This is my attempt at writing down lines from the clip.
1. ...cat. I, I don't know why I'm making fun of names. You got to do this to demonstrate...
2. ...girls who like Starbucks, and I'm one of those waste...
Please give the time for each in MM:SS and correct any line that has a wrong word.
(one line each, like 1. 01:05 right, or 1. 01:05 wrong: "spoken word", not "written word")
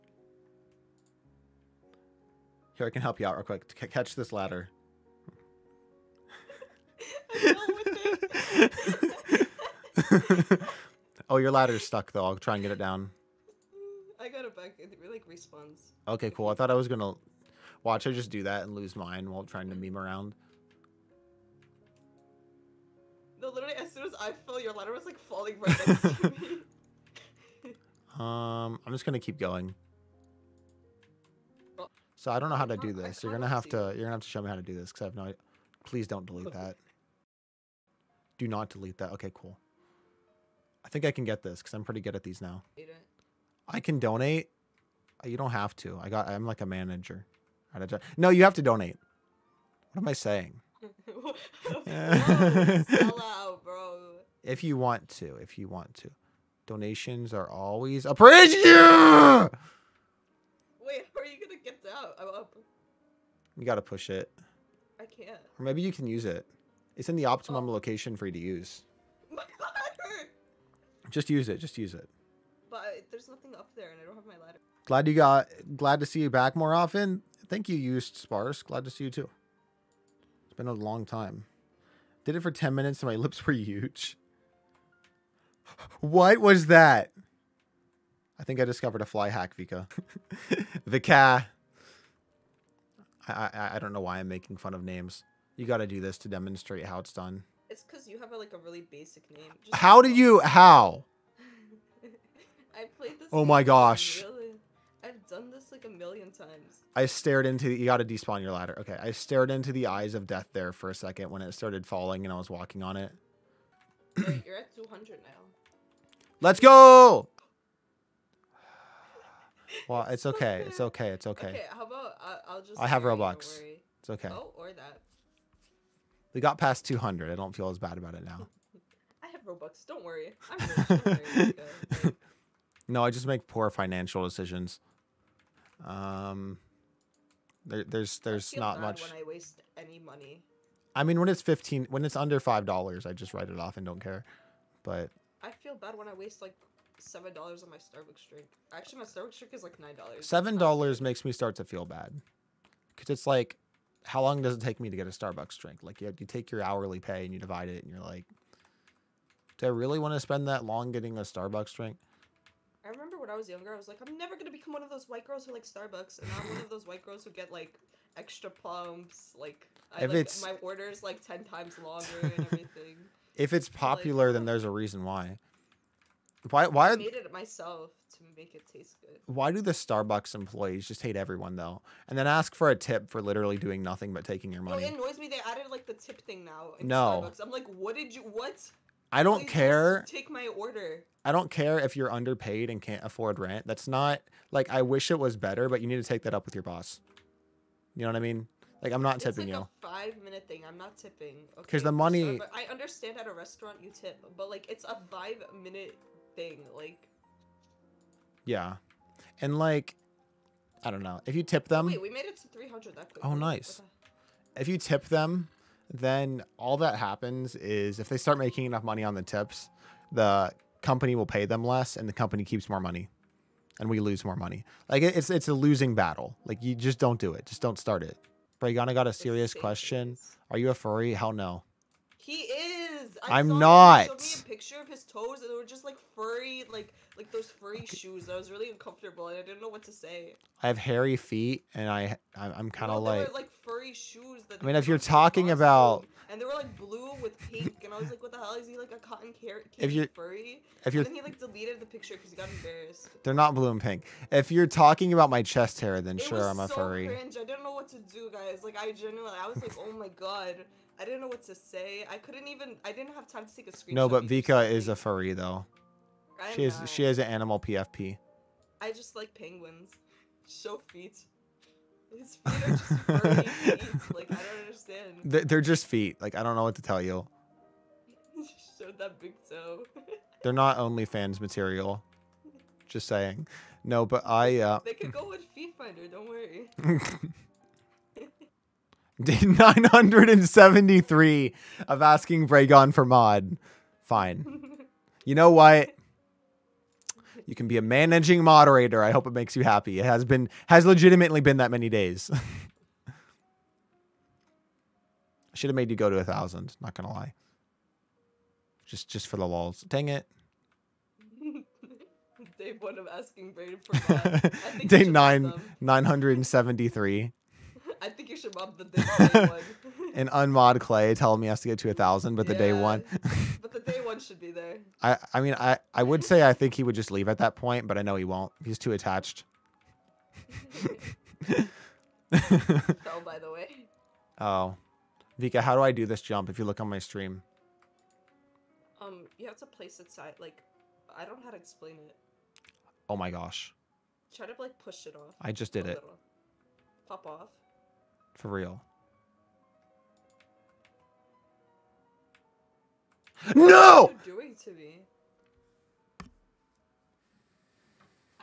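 1. 01:30 right
2. 02:45 wrong: "white", not "waste".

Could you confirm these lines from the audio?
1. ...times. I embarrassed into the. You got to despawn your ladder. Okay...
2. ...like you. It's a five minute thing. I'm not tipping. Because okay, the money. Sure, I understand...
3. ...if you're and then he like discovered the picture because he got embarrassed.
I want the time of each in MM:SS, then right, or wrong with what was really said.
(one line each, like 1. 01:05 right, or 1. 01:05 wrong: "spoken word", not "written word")
1. 01:46 wrong: "stared", not "embarrassed"
2. 03:19 right
3. 04:10 wrong: "deleted", not "discovered".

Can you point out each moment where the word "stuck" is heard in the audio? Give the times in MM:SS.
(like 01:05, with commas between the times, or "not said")
00:11.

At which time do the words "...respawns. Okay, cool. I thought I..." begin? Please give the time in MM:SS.
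00:15.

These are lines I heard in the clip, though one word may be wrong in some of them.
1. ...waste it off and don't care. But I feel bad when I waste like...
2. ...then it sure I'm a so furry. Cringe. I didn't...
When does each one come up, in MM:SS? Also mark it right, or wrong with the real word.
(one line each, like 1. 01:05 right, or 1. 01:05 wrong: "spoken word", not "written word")
1. 02:23 wrong: "write", not "waste"
2. 04:15 right.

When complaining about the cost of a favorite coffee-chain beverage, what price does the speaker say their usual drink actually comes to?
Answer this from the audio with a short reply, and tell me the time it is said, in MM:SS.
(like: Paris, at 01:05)
$9, at 02:29.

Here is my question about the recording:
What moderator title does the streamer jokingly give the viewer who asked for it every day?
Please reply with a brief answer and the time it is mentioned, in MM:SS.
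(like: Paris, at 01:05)
managing moderator, at 04:57.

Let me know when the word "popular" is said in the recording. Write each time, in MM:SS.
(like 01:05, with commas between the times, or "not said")
02:53.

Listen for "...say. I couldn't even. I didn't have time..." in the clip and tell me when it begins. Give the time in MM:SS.
04:21.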